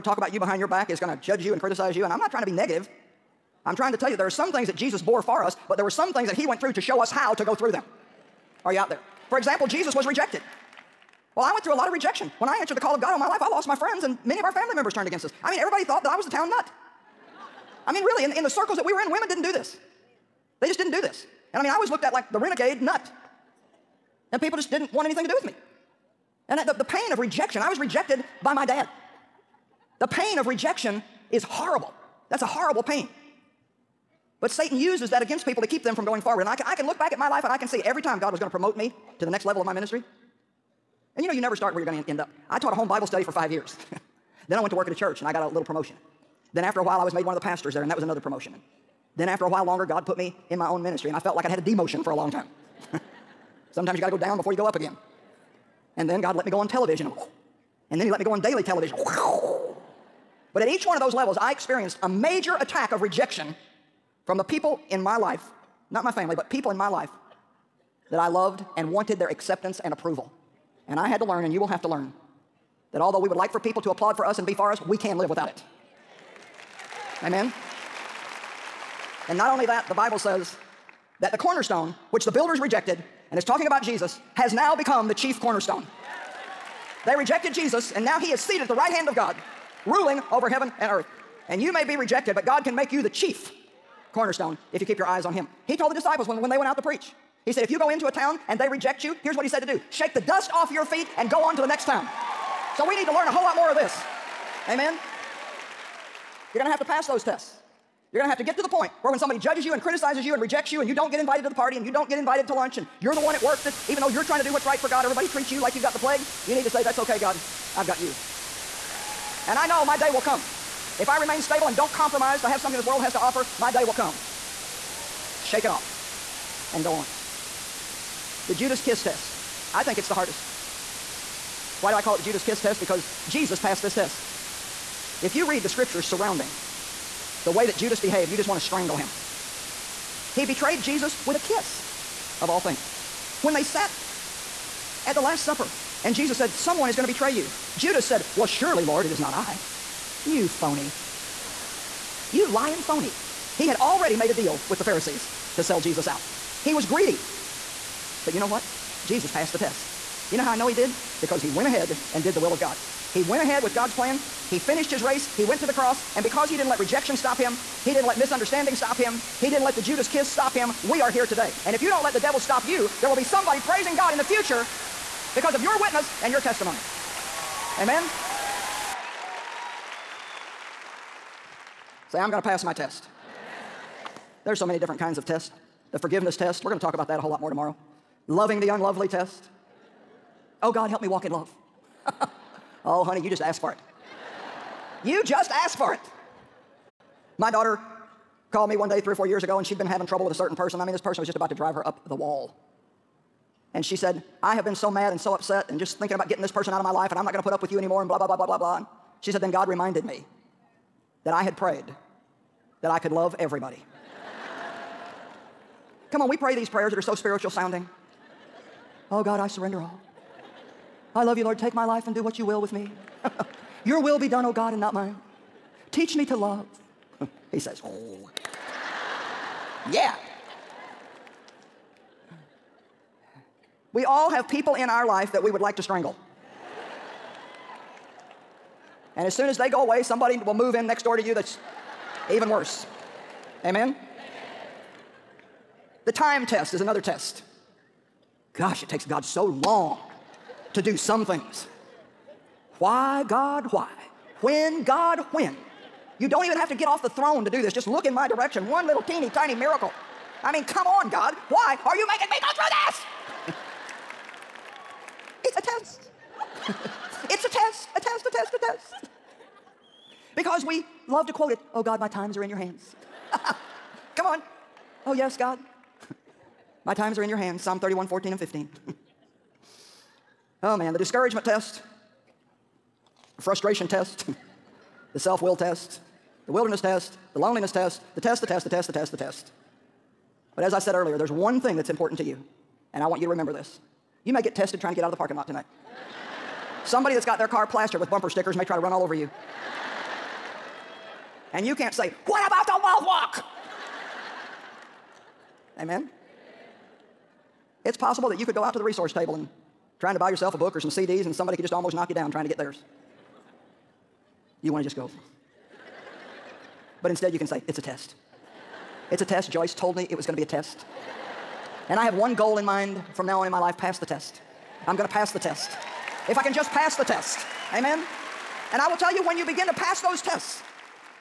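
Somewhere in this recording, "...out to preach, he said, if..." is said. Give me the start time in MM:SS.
01:36.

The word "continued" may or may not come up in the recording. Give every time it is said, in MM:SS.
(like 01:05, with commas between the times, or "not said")
not said.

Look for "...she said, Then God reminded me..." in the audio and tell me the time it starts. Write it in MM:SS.
03:29.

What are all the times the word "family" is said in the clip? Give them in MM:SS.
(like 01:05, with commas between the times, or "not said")
00:14, 01:06.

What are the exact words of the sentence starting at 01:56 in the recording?
You need to say, That's okay, God.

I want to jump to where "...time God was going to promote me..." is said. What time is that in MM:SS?
00:38.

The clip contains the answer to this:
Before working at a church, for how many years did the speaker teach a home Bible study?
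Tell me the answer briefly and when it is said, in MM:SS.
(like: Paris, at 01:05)
5, at 00:43.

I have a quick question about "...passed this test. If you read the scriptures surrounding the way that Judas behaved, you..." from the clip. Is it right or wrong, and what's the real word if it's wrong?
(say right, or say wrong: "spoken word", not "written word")
right.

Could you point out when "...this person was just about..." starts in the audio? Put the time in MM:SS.
03:20.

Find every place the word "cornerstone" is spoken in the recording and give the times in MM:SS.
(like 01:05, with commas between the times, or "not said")
01:21, 01:25, 01:34.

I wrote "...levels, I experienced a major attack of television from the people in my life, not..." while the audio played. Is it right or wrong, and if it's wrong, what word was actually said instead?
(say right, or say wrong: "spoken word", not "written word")
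wrong: "rejection", not "television".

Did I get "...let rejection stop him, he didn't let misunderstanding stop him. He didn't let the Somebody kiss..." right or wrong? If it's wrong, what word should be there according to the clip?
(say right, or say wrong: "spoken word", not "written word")
wrong: "Judas", not "Somebody".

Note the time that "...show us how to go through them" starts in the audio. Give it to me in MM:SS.
00:06.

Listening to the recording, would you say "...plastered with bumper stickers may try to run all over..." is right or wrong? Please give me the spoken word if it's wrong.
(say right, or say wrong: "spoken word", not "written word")
right.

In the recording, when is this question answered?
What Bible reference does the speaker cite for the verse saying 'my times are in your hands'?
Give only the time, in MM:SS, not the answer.
04:37.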